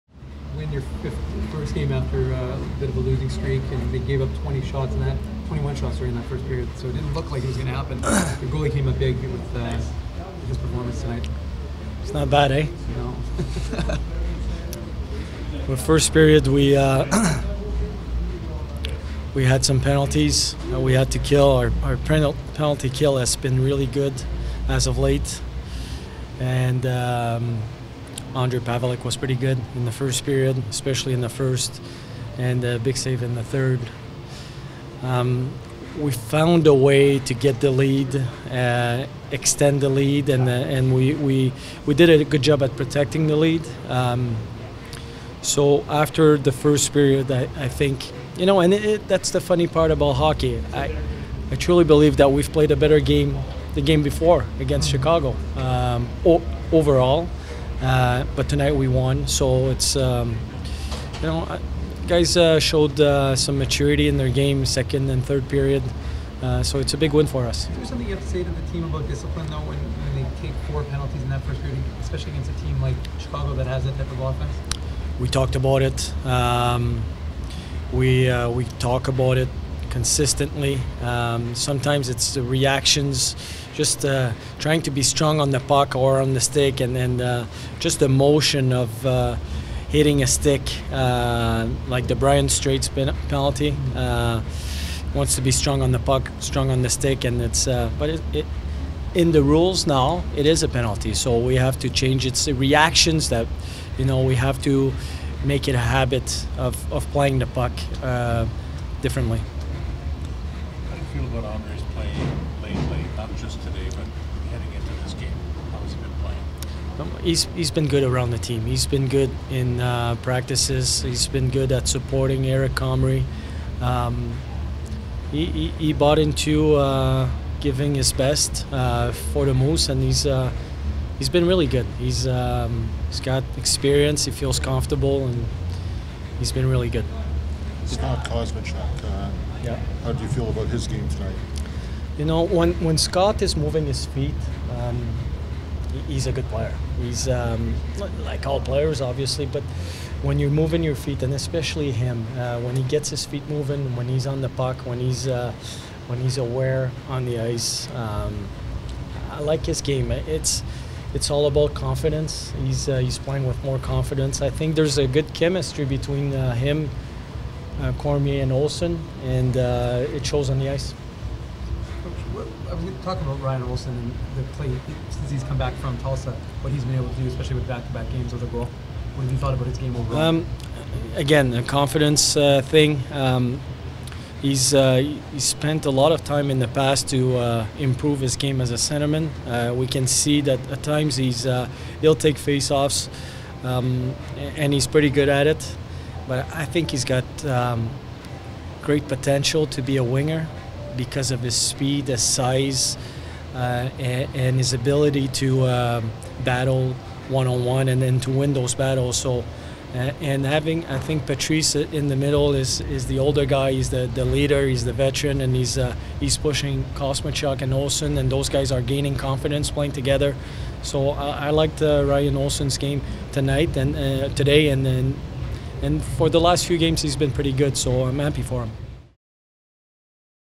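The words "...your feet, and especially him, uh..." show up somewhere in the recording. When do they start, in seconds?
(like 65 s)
150 s.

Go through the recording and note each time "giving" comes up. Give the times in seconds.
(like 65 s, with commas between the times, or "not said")
127 s.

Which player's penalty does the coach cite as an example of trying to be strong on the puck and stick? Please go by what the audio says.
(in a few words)
Brian Strait.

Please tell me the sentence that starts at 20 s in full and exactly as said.
we had to kill our our penalty kill has been really good as of late, and.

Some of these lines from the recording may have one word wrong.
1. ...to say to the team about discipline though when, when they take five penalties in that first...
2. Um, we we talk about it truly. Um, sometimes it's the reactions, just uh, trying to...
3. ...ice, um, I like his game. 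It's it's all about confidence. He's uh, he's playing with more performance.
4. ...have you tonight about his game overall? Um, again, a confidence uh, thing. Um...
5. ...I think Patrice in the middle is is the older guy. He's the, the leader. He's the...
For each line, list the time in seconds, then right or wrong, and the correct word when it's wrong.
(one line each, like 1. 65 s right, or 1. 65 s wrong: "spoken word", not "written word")
1. 68 s wrong: "four", not "five"
2. 76 s wrong: "consistently", not "truly"
3. 157 s wrong: "confidence", not "performance"
4. 179 s wrong: "thought", not "tonight"
5. 210 s right.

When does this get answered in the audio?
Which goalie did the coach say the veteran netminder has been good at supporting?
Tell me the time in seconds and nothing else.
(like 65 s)
122 s.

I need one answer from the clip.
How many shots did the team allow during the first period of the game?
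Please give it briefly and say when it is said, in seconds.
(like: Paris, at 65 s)
21, at 5 s.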